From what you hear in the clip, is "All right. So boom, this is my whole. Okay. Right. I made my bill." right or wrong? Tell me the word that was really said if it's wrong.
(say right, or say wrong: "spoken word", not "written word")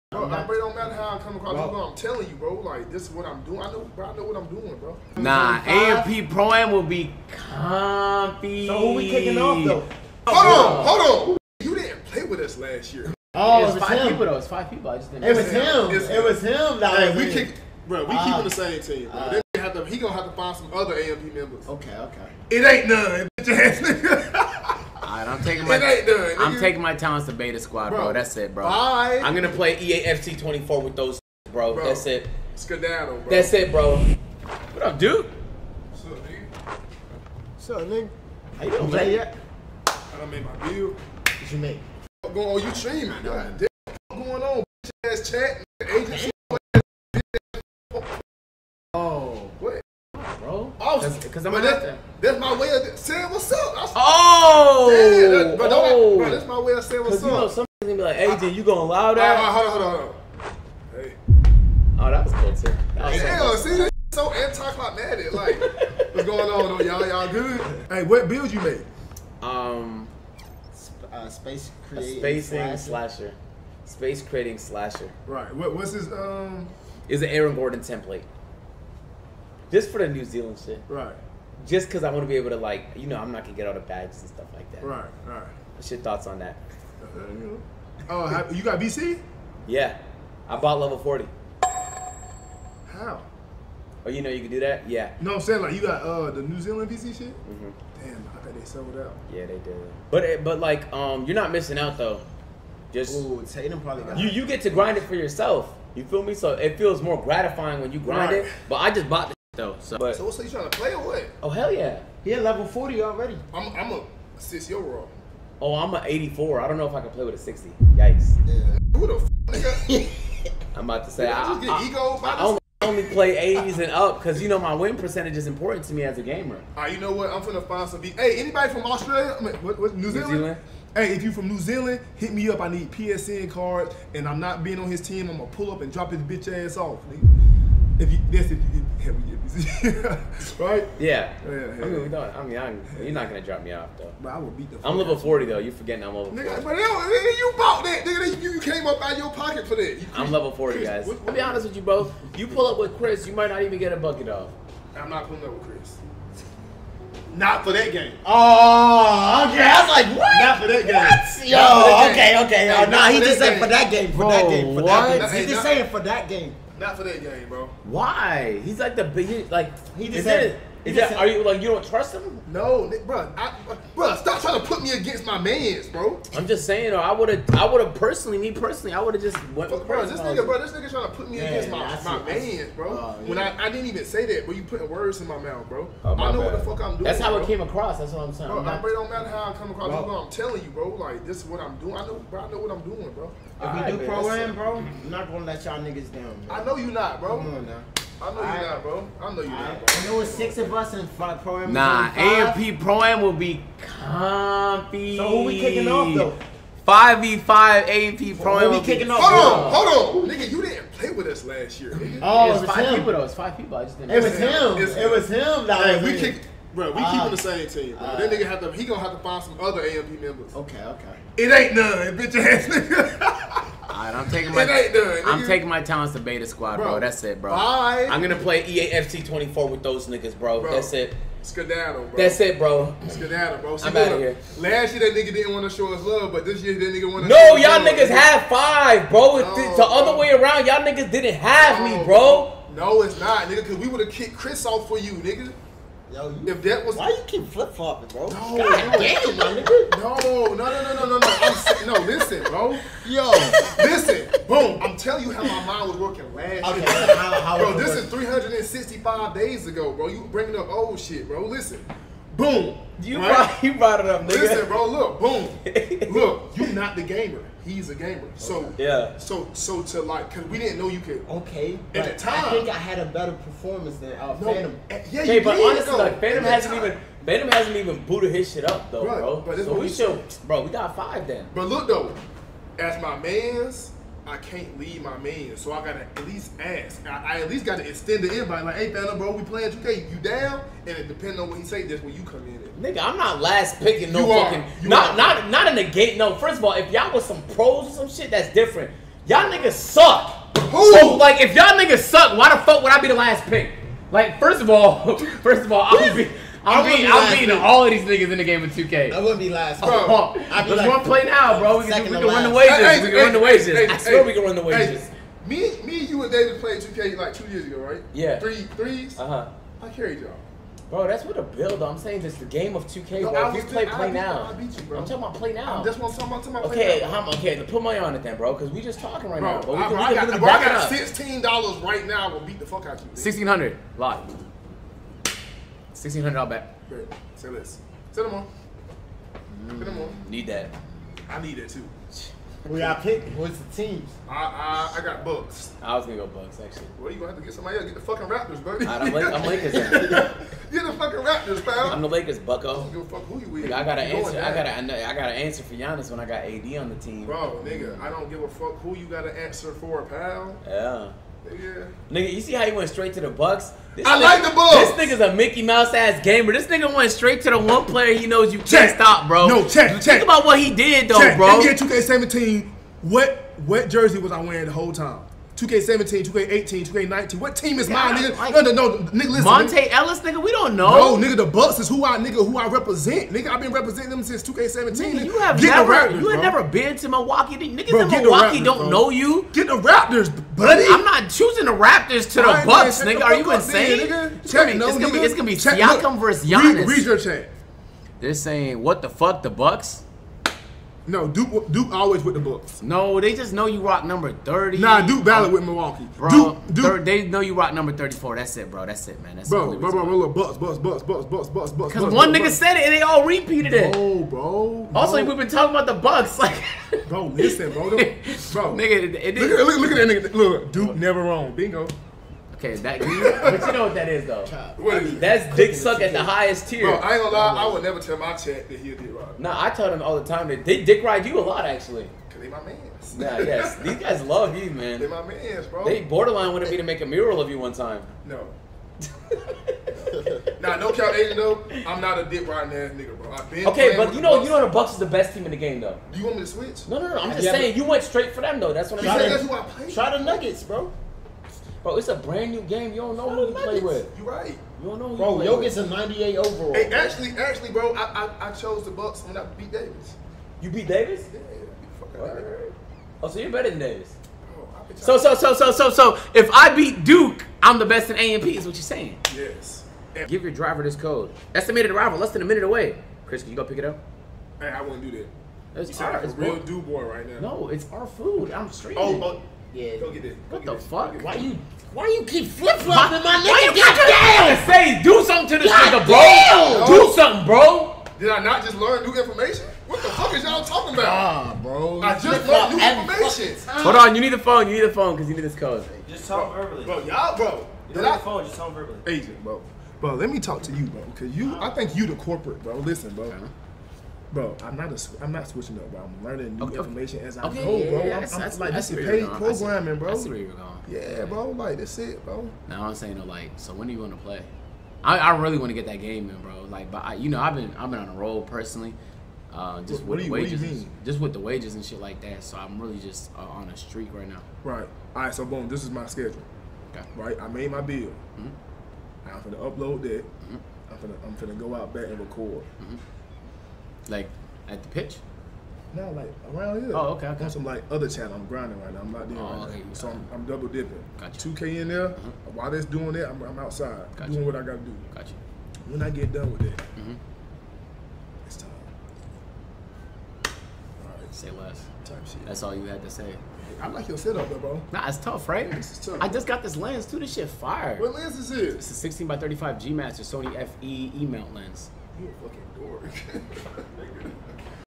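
wrong: "schedule", not "whole".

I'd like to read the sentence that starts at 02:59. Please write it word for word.
Bro, bro this nigga, bro, this nigga trying to put me yeah, against my, my man's, bro.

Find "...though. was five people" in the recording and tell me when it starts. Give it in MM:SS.
03:33.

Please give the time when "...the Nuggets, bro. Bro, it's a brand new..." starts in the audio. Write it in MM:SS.
07:30.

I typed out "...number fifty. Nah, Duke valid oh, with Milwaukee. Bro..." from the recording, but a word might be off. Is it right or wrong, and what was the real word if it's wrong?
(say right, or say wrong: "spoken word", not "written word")
wrong: "thirty", not "fifty".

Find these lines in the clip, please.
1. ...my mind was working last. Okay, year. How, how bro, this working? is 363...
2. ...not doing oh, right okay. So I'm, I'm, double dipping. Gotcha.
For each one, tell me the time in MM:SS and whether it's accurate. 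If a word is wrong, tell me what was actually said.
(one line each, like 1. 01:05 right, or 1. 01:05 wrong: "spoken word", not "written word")
1. 04:15 wrong: "365", not "363"
2. 08:59 right.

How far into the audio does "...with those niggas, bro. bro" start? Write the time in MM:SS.
03:49.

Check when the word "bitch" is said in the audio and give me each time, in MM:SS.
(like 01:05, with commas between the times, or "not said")
00:23, 00:44, 02:16, 03:42.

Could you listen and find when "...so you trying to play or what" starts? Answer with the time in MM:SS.
01:50.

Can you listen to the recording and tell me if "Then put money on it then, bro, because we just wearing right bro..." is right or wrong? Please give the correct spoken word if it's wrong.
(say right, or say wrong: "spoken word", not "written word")
wrong: "talking", not "wearing".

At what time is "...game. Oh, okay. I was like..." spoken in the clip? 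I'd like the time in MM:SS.
02:37.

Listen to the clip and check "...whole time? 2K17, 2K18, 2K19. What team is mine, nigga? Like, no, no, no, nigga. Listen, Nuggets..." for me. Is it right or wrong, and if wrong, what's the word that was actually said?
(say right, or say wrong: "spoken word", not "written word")
wrong: "Monta", not "Nuggets".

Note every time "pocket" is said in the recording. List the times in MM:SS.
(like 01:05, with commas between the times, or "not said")
02:29.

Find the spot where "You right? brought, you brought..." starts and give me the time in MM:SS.
04:23.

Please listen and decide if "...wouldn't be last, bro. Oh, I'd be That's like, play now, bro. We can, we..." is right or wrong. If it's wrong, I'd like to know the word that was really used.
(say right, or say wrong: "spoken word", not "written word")
wrong: "Let", not "That".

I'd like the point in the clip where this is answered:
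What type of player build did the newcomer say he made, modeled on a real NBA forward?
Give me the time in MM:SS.
01:13.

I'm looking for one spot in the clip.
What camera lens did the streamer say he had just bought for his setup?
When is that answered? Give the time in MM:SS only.
09:19.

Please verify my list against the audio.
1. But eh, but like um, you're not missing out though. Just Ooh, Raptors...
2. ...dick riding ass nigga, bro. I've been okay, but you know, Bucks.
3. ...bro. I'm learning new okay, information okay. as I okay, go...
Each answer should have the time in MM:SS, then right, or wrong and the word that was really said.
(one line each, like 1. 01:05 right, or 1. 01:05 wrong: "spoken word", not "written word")
1. 01:40 wrong: "Tatum", not "Raptors"
2. 07:22 right
3. 08:25 right.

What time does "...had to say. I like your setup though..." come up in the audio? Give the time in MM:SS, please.
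09:12.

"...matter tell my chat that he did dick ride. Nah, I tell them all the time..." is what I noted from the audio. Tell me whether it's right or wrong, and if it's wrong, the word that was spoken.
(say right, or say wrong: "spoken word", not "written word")
wrong: "never", not "matter".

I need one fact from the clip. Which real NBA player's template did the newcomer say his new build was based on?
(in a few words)
Aaron Gordon.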